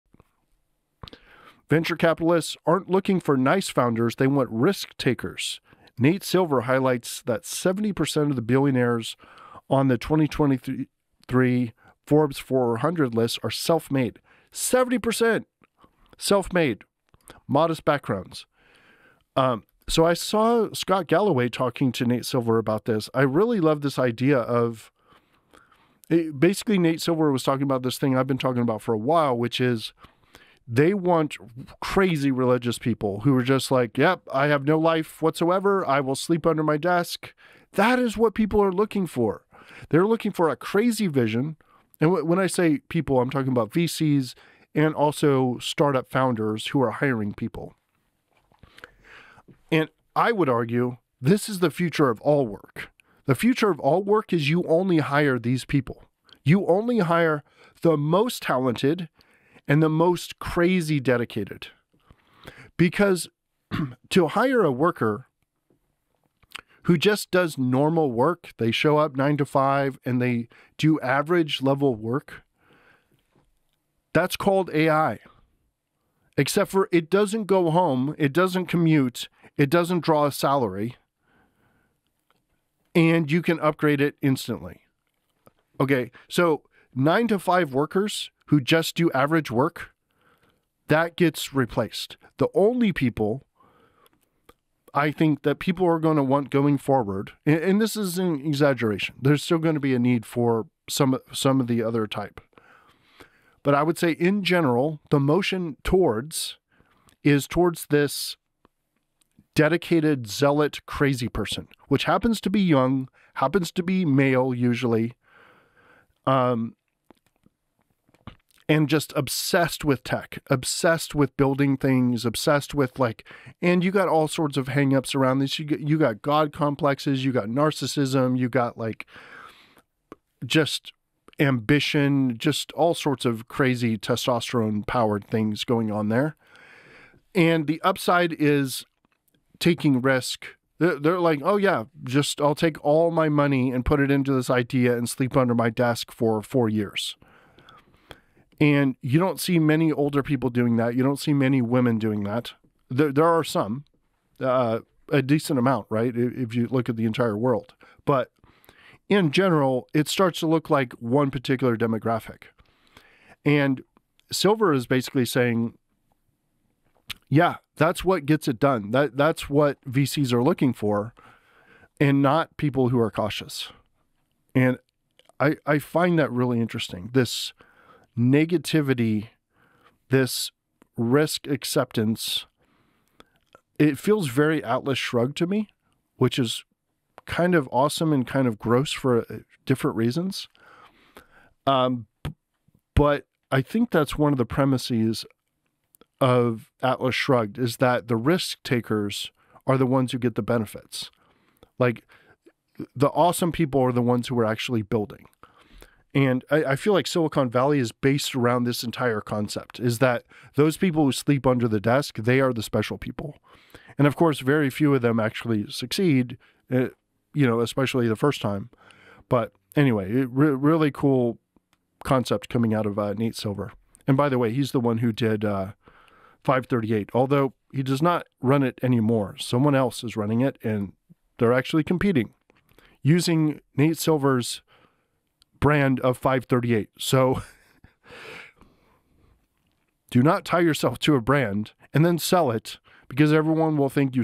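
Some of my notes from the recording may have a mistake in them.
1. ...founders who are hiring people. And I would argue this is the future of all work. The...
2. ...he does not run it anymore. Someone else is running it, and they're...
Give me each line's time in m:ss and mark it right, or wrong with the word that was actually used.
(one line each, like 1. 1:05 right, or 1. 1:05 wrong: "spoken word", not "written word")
1. 0:46 right
2. 3:47 right.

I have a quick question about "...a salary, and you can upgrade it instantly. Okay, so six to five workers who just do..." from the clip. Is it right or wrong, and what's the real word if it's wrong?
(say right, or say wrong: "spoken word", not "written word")
wrong: "nine", not "six".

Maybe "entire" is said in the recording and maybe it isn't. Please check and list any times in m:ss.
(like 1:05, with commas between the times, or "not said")
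2:37, 3:28.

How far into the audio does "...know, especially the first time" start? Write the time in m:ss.
3:37.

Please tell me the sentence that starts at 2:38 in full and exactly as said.
But in general, it starts to look like one particular demographic.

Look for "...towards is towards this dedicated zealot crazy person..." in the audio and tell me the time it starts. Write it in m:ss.
1:45.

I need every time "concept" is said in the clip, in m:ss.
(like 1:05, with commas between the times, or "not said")
3:29, 3:42.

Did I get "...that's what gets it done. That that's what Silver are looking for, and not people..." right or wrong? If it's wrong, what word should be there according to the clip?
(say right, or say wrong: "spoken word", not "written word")
wrong: "VCs", not "Silver".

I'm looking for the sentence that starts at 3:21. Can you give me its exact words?
Like the awesome people are the ones who are actually building.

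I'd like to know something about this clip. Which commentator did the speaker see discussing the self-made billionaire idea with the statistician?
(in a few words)
Scott Galloway.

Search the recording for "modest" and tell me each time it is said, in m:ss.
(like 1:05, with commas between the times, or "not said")
0:17.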